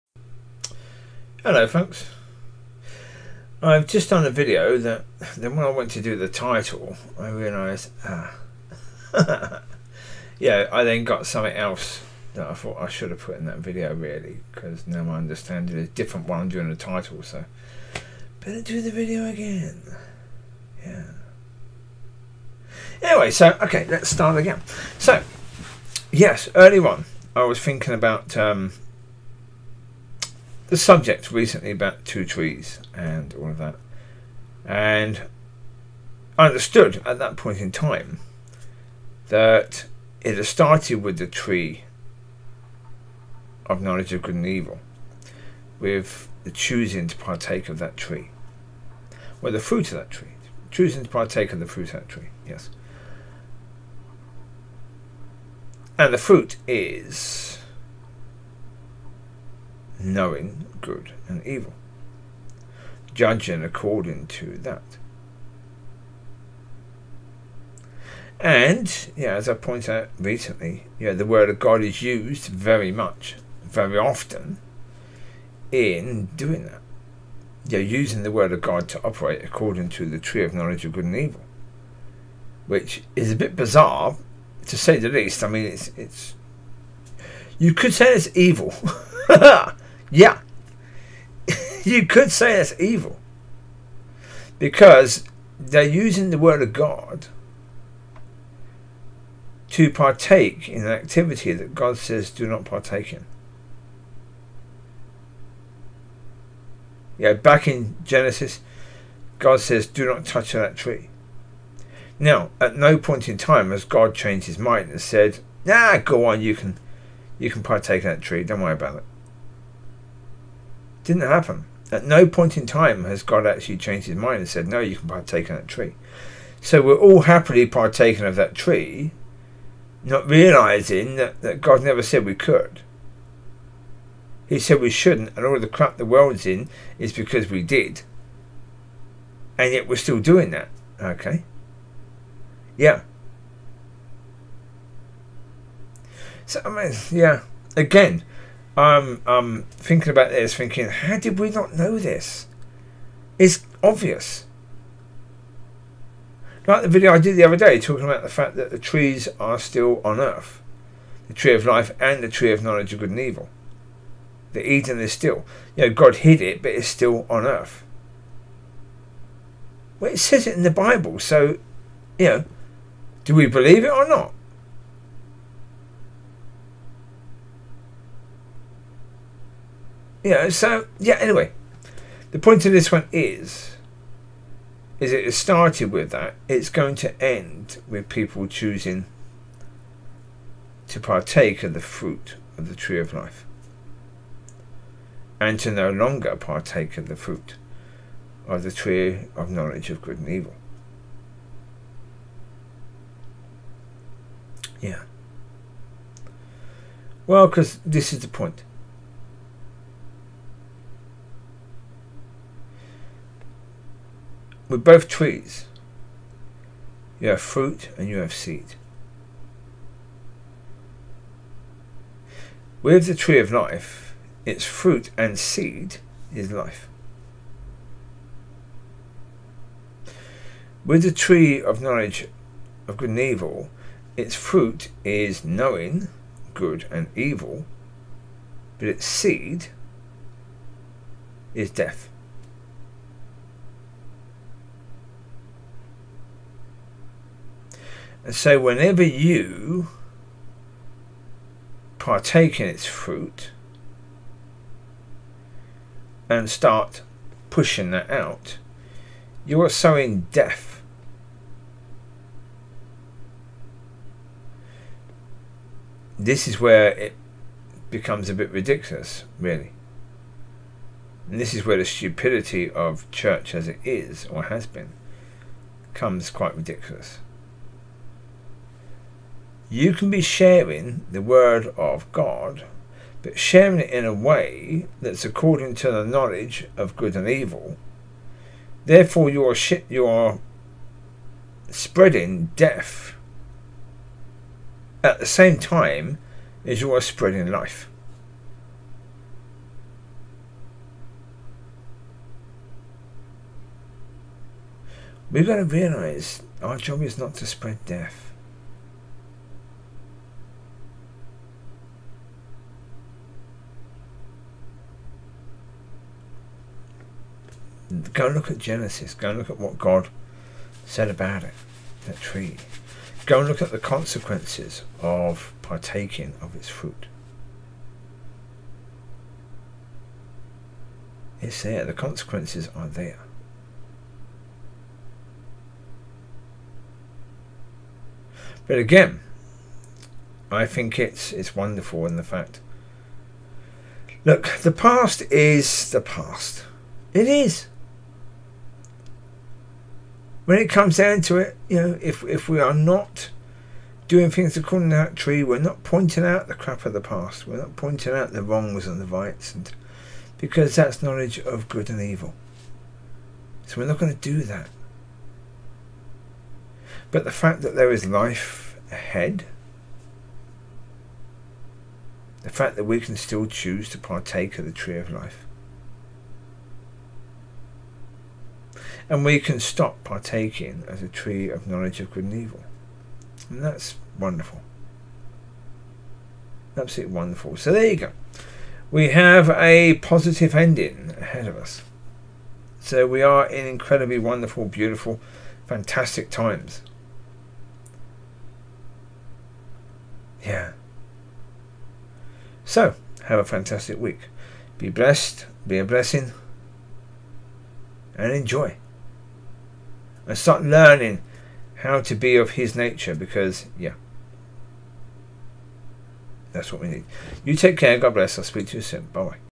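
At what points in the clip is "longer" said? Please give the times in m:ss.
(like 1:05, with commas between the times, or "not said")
3:15.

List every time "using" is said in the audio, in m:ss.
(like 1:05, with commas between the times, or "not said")
1:17, 1:35.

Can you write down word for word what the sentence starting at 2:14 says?
He said we shouldn't, and all the crap the world's in is because we did.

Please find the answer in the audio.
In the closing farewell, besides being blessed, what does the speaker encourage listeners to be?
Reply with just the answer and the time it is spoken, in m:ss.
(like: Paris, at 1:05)
A blessing, at 6:45.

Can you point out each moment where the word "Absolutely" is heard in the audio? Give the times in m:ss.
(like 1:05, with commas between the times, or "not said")
6:26.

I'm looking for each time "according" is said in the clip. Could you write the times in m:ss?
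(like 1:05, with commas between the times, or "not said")
1:03, 1:19, 4:45, 5:54.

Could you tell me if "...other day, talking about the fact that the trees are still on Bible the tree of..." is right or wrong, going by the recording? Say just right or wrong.
wrong.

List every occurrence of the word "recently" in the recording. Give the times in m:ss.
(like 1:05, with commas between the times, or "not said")
0:31, 1:10.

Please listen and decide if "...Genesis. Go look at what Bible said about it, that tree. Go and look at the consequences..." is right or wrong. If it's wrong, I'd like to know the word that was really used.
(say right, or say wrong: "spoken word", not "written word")
wrong: "God", not "Bible".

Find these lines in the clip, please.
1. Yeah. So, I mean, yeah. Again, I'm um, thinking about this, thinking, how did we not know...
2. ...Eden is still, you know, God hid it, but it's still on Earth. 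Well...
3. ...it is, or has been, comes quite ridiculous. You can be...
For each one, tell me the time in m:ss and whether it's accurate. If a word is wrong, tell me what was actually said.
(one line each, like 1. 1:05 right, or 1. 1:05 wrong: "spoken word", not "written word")
1. 2:22 right
2. 2:44 right
3. 4:33 right.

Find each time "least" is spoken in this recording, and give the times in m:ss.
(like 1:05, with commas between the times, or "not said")
1:25.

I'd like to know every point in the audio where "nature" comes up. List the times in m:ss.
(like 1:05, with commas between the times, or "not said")
6:52.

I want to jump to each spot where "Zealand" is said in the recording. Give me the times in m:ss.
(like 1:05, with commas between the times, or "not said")
not said.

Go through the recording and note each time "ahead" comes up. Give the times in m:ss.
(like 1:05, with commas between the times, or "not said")
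6:08, 6:31.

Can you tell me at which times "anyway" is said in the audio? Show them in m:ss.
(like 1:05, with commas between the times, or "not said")
0:23, 3:01.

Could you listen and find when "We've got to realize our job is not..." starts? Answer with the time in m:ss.
5:05.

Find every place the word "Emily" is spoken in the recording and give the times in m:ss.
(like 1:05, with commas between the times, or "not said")
not said.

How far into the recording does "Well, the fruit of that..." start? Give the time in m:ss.
0:49.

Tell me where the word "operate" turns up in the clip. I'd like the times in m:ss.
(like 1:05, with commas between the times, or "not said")
1:19.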